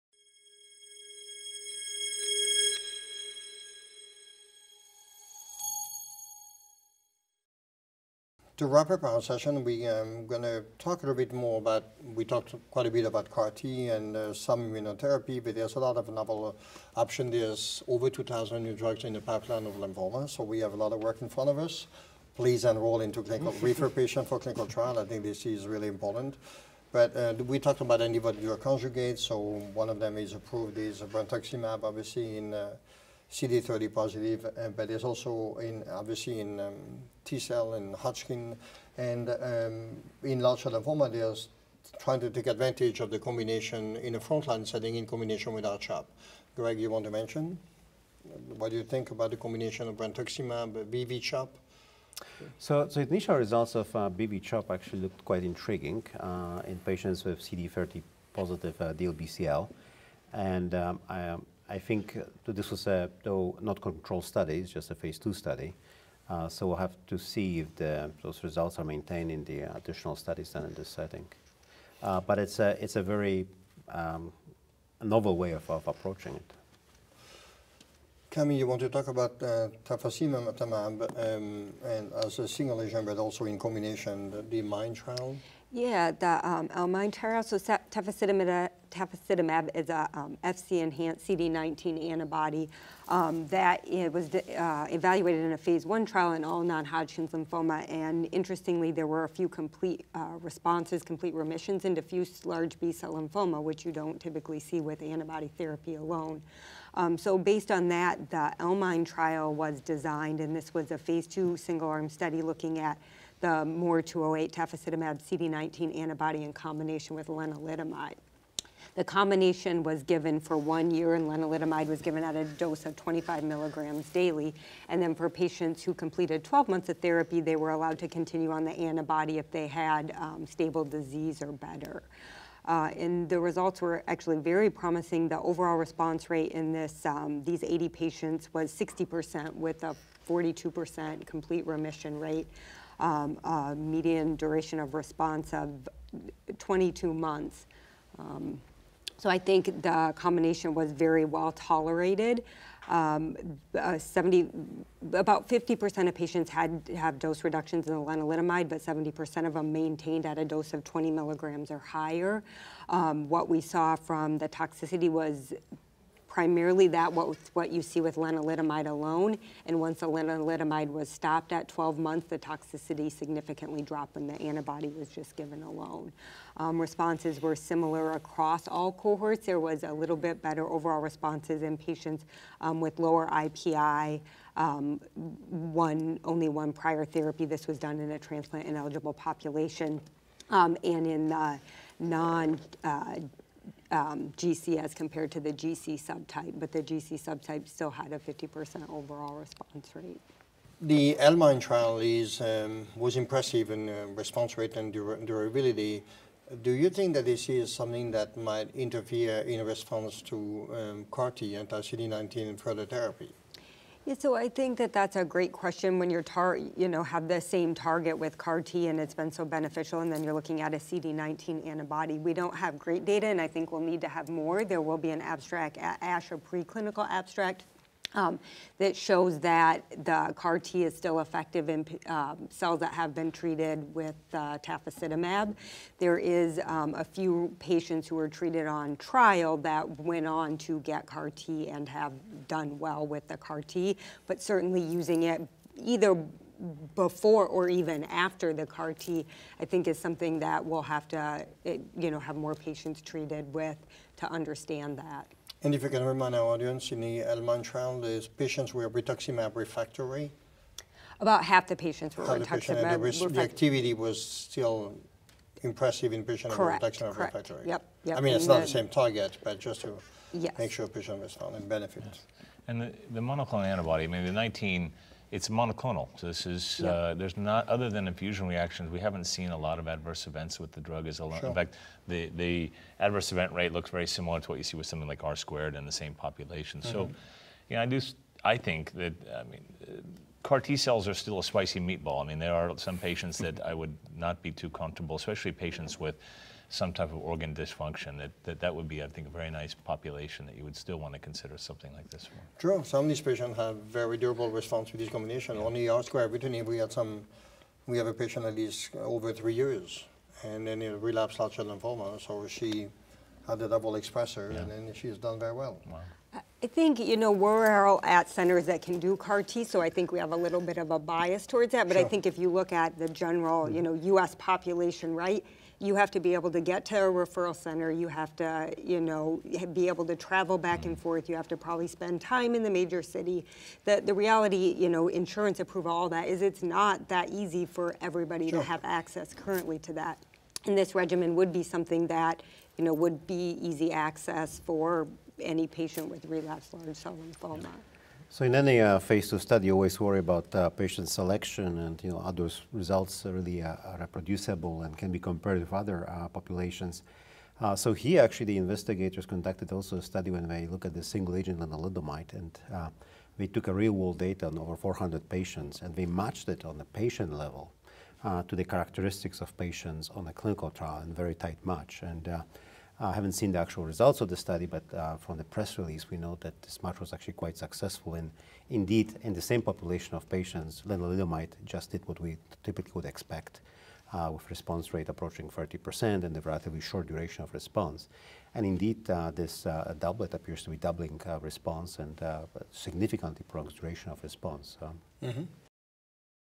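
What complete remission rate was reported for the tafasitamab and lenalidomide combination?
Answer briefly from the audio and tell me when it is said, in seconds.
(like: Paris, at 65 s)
42%, at 140 s.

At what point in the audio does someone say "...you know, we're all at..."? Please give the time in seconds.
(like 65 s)
316 s.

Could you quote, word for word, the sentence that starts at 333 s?
The, the reality, you know, insurance approval, all that, is it's not that easy for everybody sure.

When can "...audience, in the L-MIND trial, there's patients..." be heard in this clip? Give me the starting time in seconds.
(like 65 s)
256 s.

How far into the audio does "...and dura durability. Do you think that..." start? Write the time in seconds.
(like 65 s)
204 s.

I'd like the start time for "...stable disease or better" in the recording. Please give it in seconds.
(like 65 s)
130 s.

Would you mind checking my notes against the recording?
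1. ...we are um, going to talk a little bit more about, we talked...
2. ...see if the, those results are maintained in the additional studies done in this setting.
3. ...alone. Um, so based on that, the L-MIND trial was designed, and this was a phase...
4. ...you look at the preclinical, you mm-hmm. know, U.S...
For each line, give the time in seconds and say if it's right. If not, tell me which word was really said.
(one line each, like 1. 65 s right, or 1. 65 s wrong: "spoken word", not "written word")
1. 9 s right
2. 67 s right
3. 105 s right
4. 322 s wrong: "general", not "preclinical".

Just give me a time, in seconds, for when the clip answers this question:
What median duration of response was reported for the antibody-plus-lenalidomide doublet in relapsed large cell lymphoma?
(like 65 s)
146 s.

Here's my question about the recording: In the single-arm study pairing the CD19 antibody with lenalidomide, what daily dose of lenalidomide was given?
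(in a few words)
25 milligrams.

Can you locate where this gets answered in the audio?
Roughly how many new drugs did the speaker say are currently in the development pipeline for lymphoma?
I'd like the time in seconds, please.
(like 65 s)
18 s.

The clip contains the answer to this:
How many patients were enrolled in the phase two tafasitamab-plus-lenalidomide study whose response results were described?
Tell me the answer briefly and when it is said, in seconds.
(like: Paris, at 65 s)
80, at 137 s.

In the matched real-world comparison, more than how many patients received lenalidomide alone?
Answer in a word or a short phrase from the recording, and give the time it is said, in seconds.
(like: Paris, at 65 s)
400, at 364 s.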